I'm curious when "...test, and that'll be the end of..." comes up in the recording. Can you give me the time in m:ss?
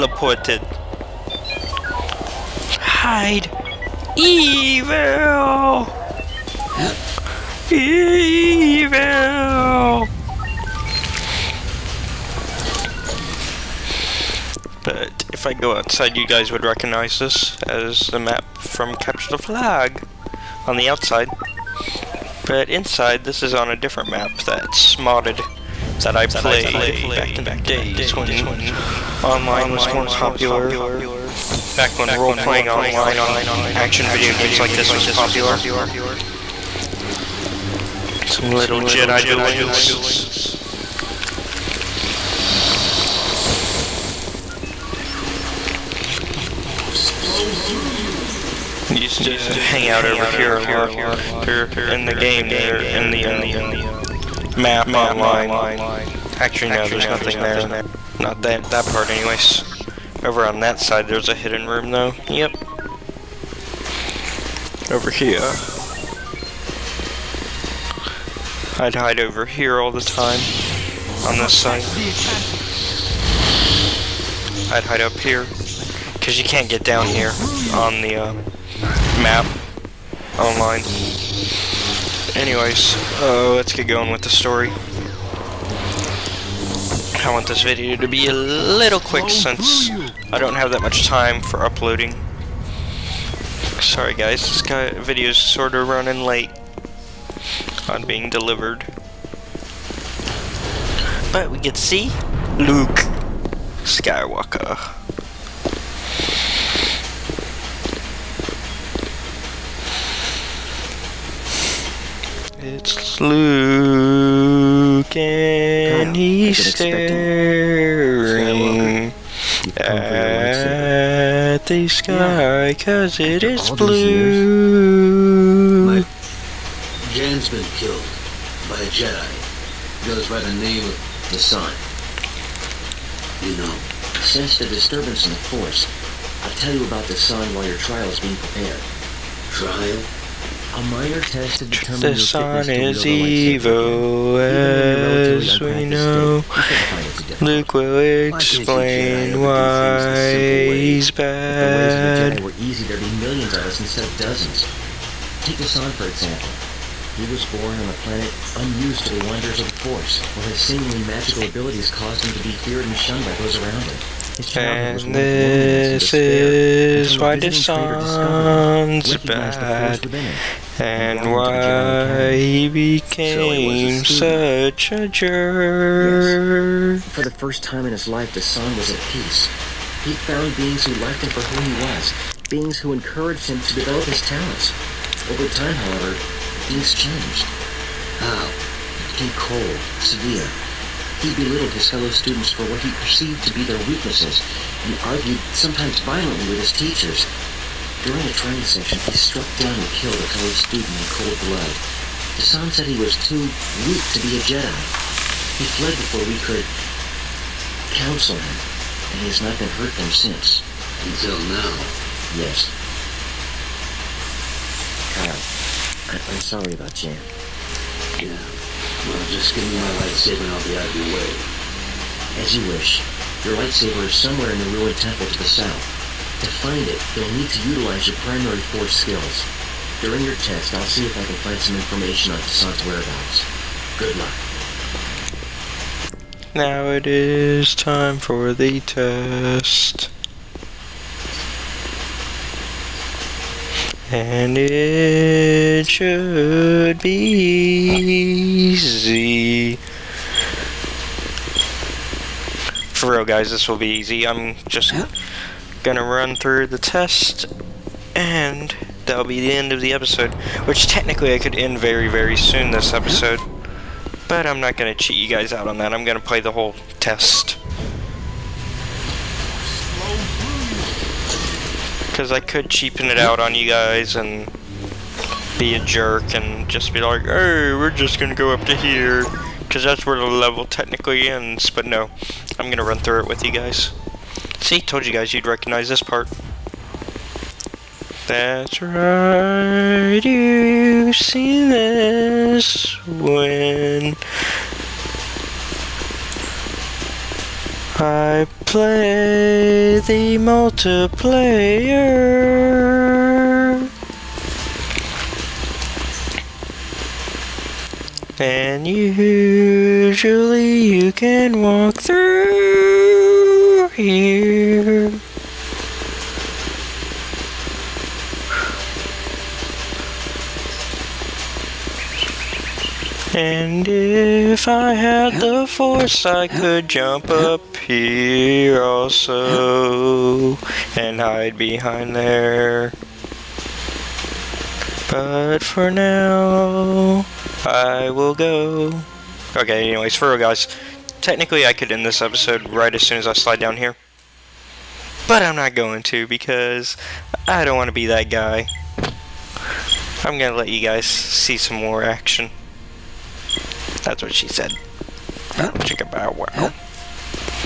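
4:16.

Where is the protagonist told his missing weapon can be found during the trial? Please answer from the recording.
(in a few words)
the ruined temple to the south.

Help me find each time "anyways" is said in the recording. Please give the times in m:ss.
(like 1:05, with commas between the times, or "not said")
0:59, 1:22, 5:39.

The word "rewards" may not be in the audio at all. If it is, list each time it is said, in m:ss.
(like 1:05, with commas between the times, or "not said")
not said.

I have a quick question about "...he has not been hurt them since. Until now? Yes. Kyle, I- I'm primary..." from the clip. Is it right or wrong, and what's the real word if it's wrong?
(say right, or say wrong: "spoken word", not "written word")
wrong: "sorry", not "primary".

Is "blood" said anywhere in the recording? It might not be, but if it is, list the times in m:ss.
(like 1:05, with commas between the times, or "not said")
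3:21.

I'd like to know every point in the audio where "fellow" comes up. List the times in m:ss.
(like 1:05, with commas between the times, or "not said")
3:11, 3:20.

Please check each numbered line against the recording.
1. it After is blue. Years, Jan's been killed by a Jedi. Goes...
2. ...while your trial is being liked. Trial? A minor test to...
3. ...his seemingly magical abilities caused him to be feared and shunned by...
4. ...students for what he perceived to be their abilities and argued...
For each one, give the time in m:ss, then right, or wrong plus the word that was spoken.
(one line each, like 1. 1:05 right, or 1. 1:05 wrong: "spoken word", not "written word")
1. 2:03 right
2. 2:17 wrong: "prepared", not "liked"
3. 2:40 right
4. 3:12 wrong: "weaknesses", not "abilities".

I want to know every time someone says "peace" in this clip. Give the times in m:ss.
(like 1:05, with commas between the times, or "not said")
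2:59.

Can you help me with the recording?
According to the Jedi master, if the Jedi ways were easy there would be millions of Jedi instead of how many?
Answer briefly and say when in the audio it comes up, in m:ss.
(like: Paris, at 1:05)
dozens, at 2:34.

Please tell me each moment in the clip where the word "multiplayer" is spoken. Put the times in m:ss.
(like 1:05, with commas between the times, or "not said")
5:00.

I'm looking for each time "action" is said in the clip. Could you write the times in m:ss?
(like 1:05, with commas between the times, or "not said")
0:33, 5:52.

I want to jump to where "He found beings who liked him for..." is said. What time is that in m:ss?
3:00.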